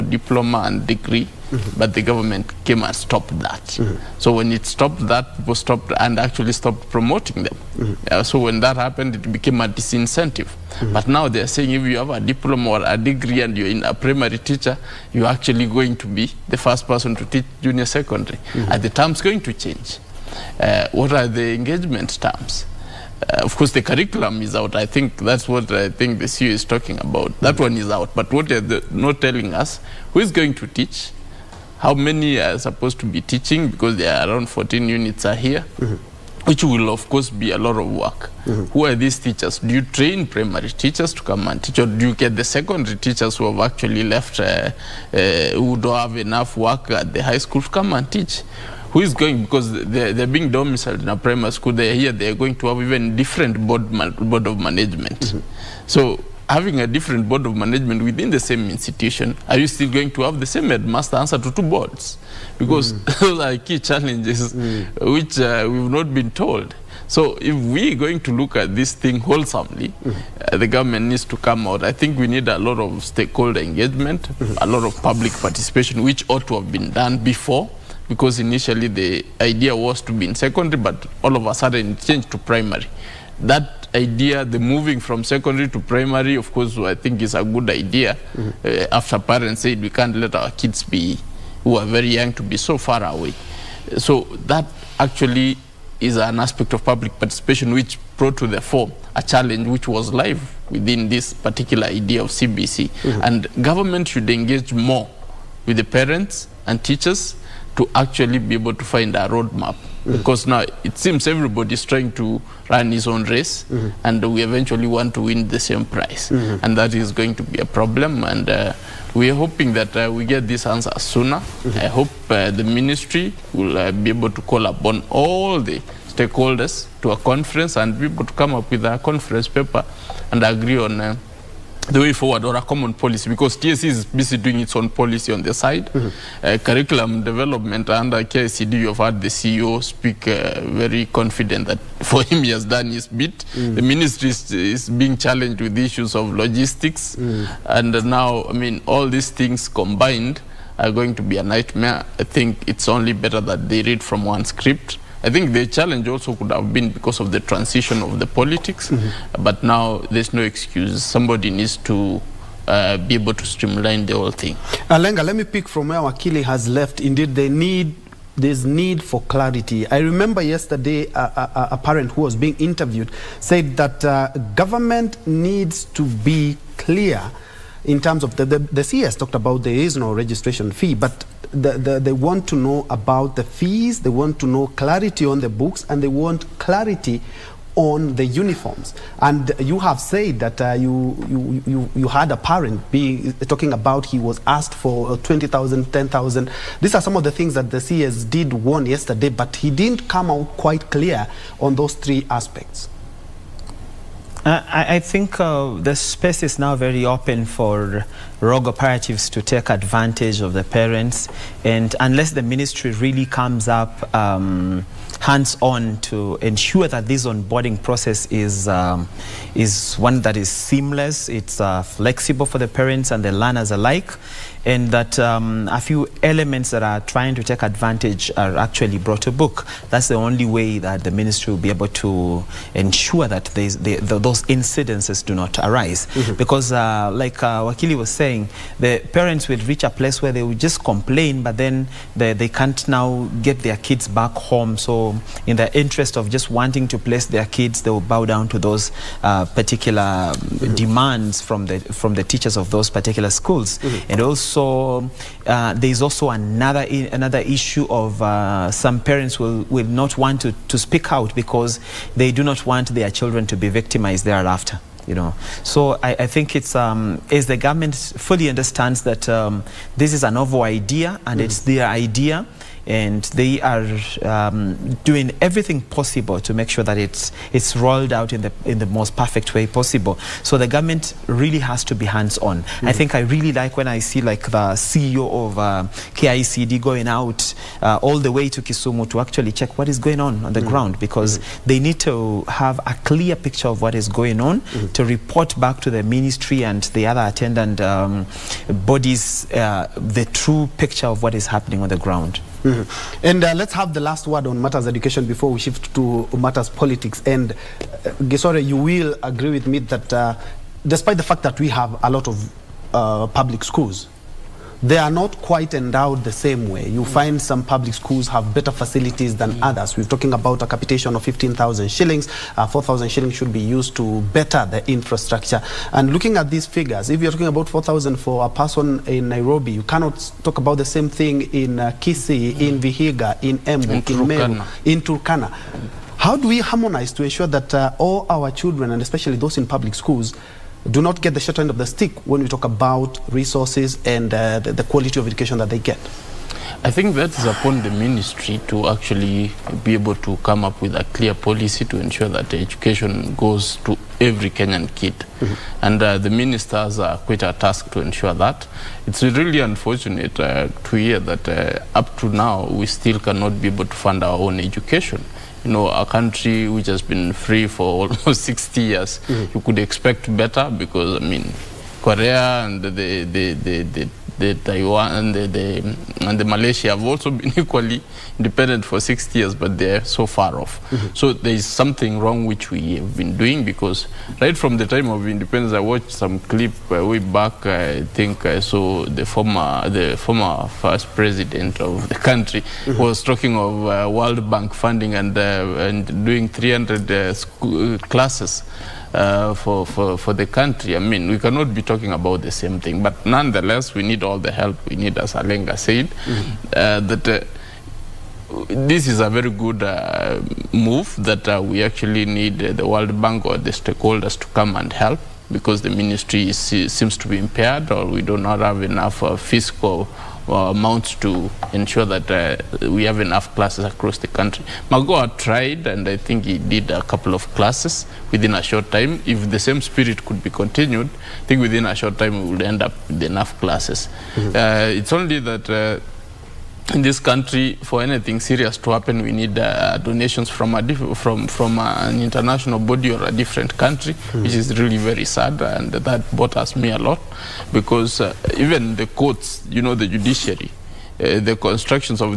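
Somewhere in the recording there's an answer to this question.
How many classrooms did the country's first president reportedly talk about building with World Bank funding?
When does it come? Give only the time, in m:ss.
6:36.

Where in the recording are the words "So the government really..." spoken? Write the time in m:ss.
4:40.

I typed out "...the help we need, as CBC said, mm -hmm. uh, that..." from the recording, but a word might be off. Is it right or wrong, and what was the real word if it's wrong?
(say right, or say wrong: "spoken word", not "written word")
wrong: "Alenga", not "CBC".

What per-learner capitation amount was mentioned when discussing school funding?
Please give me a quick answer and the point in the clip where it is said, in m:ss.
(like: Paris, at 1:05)
15,000 shillings, at 5:21.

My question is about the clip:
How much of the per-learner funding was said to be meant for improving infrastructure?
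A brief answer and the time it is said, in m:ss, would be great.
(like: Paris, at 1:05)
4,000 shillings, at 5:22.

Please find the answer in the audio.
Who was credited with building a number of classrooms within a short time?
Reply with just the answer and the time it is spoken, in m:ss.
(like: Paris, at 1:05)
Magoa, at 7:04.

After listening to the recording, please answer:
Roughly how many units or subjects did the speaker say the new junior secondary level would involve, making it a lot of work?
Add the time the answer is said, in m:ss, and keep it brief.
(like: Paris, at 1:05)
14, at 0:34.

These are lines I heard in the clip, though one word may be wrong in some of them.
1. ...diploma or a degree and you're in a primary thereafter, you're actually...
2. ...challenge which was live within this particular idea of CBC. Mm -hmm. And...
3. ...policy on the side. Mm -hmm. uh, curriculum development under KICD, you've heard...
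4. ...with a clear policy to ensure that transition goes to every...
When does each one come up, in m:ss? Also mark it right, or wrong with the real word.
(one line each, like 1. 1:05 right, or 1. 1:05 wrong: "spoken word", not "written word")
1. 0:12 wrong: "teacher", not "thereafter"
2. 1:39 right
3. 2:14 right
4. 5:50 wrong: "education", not "transition".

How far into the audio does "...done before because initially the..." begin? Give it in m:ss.
1:16.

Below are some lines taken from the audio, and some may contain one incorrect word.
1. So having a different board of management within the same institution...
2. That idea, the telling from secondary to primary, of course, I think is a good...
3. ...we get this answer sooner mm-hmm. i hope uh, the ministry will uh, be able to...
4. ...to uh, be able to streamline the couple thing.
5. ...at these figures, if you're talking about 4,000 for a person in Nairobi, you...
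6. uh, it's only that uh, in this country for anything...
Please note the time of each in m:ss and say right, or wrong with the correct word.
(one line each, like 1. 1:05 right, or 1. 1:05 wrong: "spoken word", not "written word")
1. 0:55 right
2. 1:23 wrong: "moving", not "telling"
3. 2:00 right
4. 2:41 wrong: "whole", not "couple"
5. 5:26 right
6. 7:14 right.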